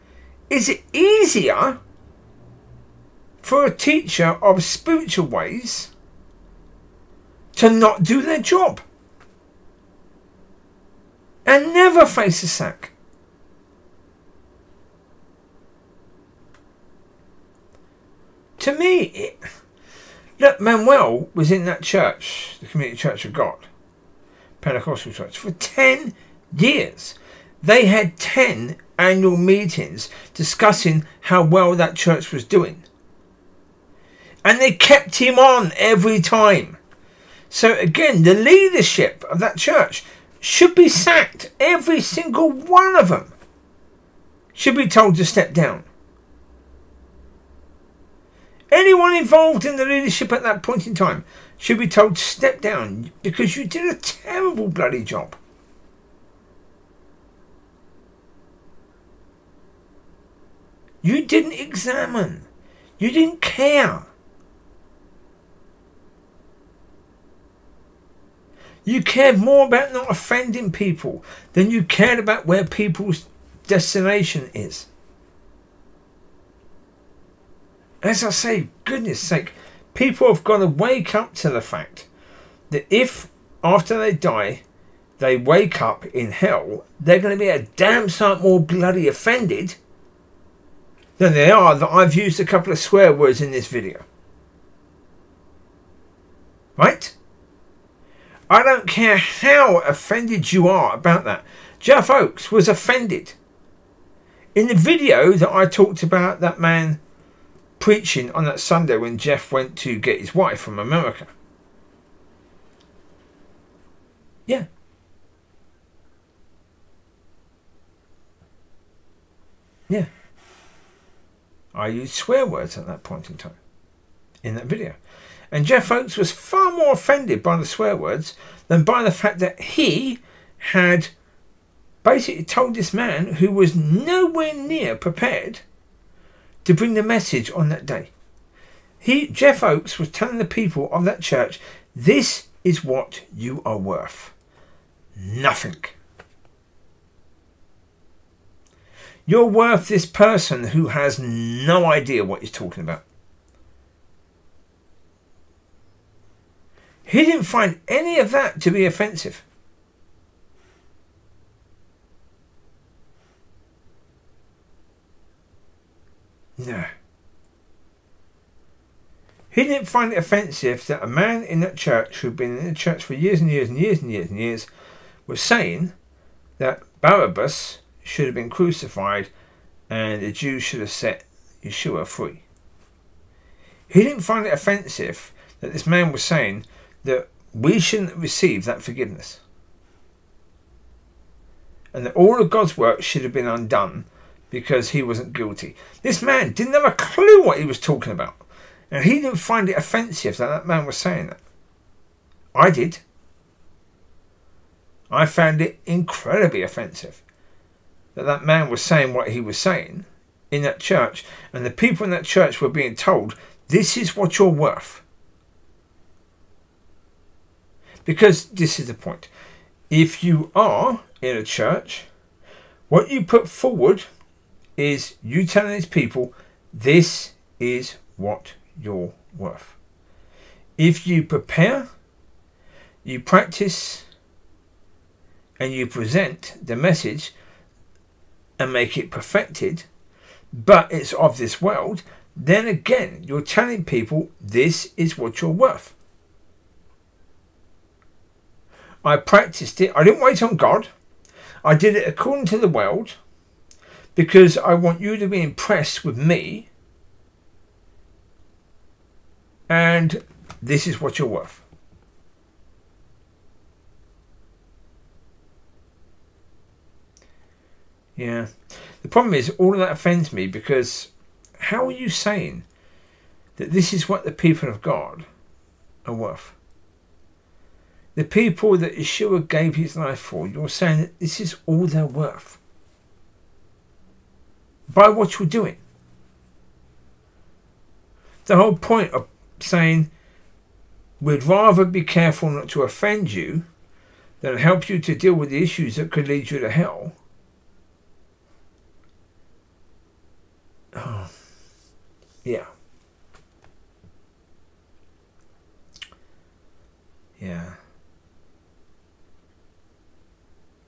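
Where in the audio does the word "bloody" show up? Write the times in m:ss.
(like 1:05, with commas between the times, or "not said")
0:54, 1:28.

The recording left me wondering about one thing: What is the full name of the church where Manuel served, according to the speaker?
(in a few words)
Community Church of God.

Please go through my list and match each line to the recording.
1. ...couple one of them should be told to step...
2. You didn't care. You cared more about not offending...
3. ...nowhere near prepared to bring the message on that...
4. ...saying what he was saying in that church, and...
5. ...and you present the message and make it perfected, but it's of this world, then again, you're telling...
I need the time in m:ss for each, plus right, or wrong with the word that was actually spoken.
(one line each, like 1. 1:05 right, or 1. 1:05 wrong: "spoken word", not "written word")
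1. 0:41 wrong: "single", not "couple"
2. 1:02 right
3. 2:13 right
4. 3:28 right
5. 3:55 right.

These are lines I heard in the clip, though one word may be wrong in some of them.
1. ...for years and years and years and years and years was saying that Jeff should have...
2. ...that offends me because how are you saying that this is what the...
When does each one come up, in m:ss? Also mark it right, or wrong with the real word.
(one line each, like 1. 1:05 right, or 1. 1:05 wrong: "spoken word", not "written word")
1. 2:53 wrong: "Barabbas", not "Jeff"
2. 4:29 right.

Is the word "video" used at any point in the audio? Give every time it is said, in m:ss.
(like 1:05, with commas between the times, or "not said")
1:33, 1:44, 2:04.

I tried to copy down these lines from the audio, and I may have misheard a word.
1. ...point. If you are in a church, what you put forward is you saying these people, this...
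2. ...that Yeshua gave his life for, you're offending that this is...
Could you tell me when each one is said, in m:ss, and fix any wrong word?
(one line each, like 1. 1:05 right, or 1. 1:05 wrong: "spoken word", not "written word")
1. 3:38 wrong: "telling", not "saying"
2. 4:38 wrong: "saying", not "offending".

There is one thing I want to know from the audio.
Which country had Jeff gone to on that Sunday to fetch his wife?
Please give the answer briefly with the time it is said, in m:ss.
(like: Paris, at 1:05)
America, at 1:50.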